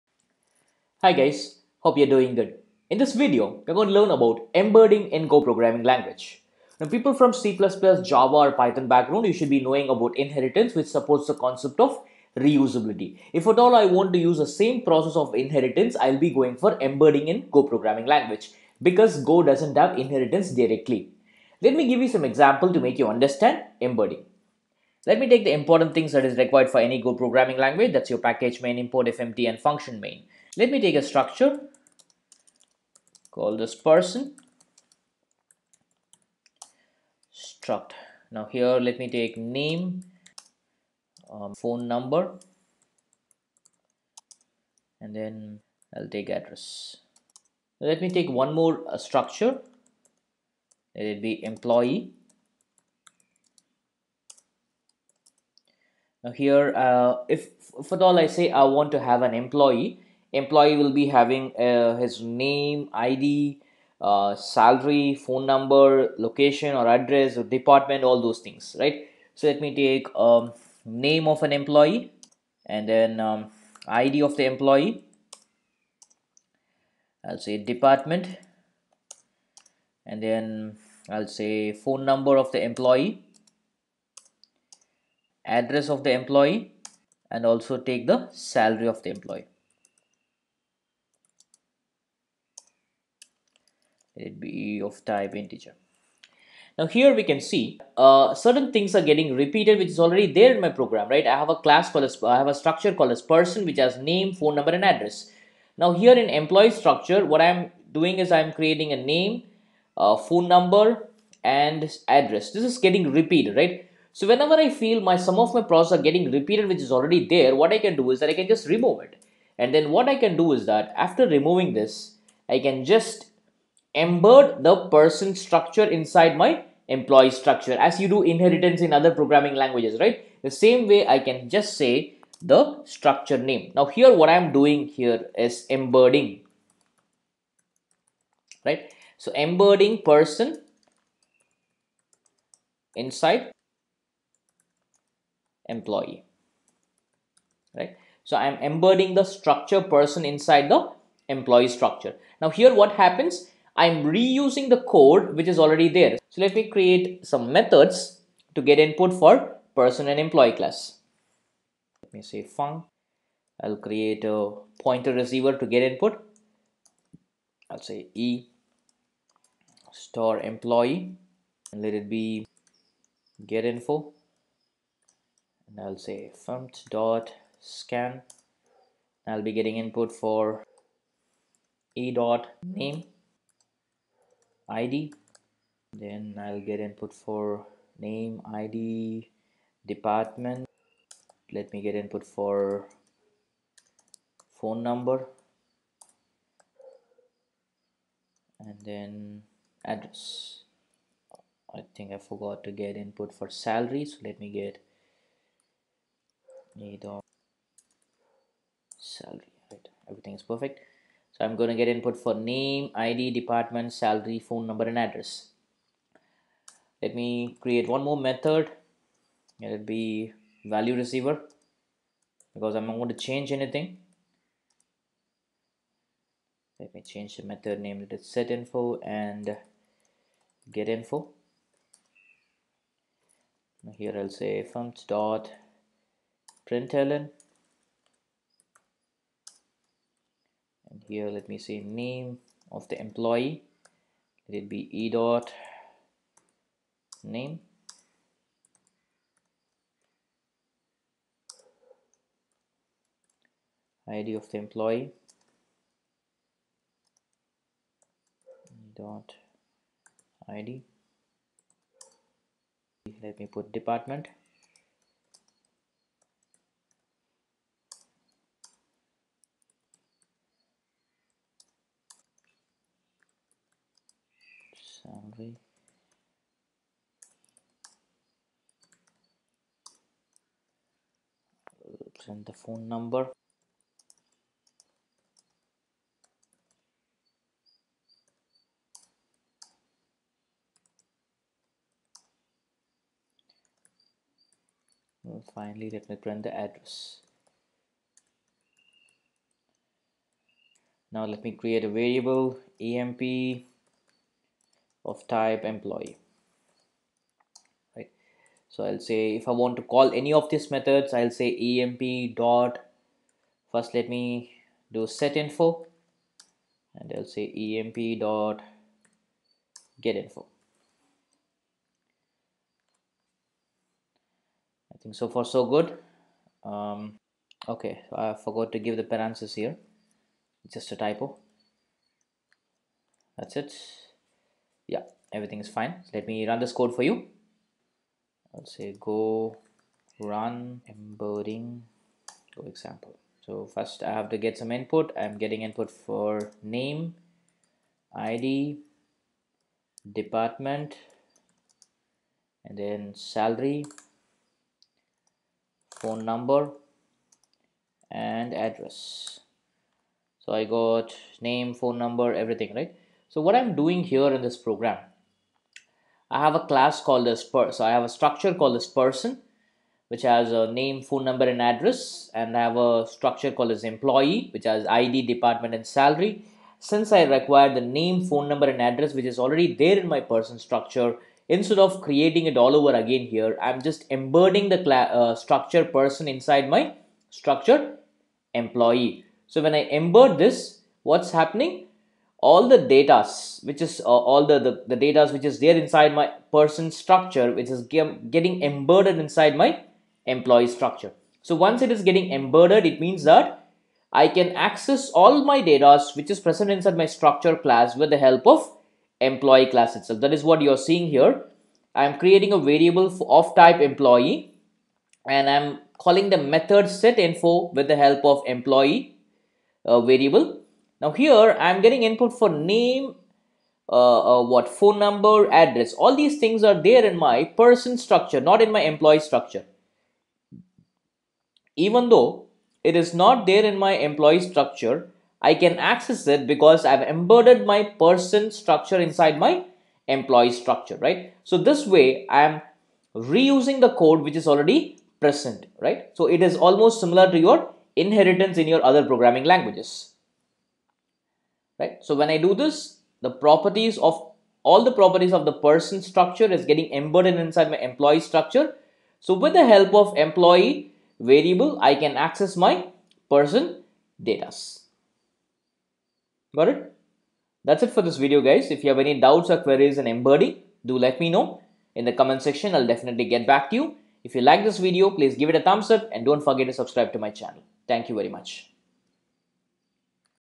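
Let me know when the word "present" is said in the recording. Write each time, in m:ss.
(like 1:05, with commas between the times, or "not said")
6:46, 7:25.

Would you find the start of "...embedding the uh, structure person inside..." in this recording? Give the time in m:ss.
6:24.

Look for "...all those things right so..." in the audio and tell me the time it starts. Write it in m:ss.
1:08.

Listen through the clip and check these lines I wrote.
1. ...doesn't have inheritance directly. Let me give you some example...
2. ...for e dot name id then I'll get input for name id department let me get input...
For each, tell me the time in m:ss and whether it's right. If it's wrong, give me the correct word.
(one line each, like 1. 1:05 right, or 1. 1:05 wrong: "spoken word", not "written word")
1. 0:19 right
2. 3:00 right.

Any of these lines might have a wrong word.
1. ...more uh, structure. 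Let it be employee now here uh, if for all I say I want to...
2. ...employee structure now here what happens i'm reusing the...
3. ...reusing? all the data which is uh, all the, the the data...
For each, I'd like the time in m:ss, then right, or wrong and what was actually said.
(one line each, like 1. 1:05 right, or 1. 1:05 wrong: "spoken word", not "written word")
1. 0:48 right
2. 2:31 right
3. 6:31 wrong: "happening", not "reusing".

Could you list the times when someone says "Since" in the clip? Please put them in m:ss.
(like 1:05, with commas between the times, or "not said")
6:16.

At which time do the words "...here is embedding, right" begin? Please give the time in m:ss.
2:14.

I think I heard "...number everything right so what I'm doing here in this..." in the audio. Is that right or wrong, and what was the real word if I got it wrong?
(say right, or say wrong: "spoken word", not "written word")
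right.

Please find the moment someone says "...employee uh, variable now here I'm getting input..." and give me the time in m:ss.
6:58.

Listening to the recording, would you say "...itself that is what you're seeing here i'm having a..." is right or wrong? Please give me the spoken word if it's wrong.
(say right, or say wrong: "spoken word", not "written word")
wrong: "creating", not "having".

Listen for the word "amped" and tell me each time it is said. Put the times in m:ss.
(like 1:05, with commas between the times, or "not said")
not said.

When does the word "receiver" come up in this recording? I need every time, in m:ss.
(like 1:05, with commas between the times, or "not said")
2:45, 3:40.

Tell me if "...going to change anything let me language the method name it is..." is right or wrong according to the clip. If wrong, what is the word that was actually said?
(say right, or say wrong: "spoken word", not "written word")
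wrong: "change", not "language".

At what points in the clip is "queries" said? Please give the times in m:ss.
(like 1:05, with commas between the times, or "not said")
7:49.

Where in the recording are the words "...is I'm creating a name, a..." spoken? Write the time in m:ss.
1:48.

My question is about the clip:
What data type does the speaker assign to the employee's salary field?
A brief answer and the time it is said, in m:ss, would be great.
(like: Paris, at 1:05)
integer, at 1:35.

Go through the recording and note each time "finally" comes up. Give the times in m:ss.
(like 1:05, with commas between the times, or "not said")
4:55.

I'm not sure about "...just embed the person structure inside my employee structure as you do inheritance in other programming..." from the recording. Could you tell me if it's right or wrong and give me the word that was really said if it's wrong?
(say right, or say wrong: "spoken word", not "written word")
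right.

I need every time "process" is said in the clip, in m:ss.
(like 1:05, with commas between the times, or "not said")
0:14, 1:55.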